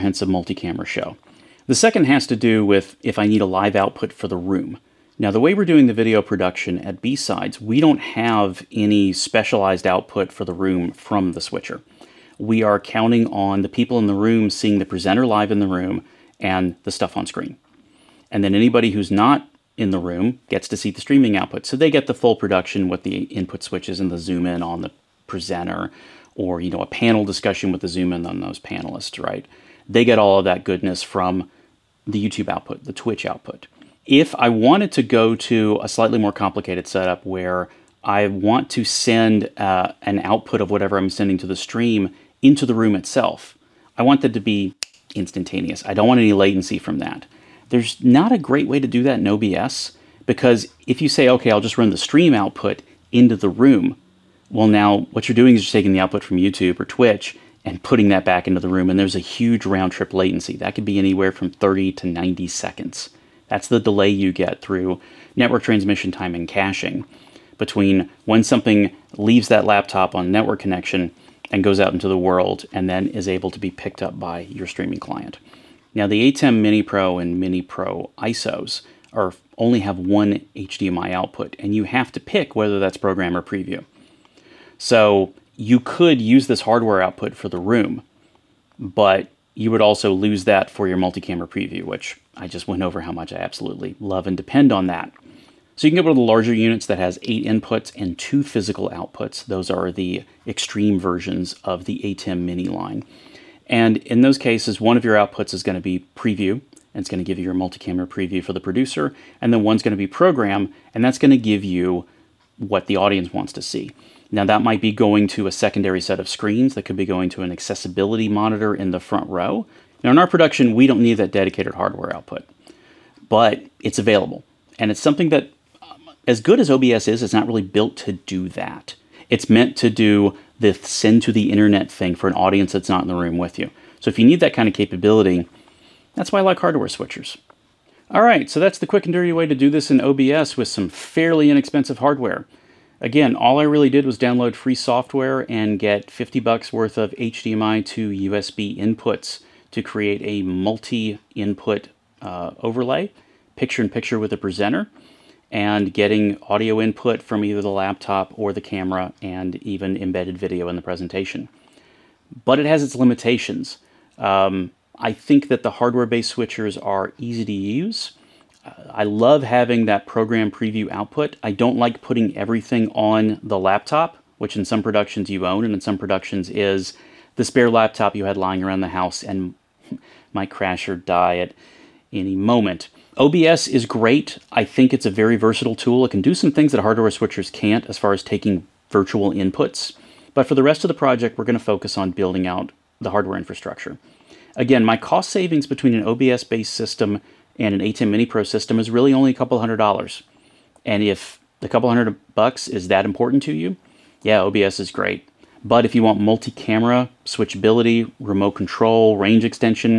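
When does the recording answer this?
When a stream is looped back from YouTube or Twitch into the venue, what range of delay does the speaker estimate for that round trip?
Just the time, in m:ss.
1:01.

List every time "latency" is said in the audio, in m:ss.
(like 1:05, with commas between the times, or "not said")
0:46, 1:00.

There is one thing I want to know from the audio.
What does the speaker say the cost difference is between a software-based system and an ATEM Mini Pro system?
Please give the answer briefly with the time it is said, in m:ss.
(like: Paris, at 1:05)
a couple hundred dollars, at 3:19.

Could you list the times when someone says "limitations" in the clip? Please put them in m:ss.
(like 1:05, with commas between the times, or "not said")
2:42.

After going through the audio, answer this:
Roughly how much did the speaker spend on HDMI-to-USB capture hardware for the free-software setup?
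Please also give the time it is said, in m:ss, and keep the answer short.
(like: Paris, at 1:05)
50 bucks, at 2:26.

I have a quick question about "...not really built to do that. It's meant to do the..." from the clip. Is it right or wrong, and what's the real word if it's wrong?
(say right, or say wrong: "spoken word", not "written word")
right.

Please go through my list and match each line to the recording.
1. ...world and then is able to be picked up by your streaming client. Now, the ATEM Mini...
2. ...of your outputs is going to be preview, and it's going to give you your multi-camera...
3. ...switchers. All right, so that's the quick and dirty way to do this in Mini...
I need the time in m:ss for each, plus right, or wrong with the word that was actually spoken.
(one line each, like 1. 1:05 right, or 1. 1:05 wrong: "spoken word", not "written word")
1. 1:12 right
2. 1:44 right
3. 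2:16 wrong: "OBS", not "Mini".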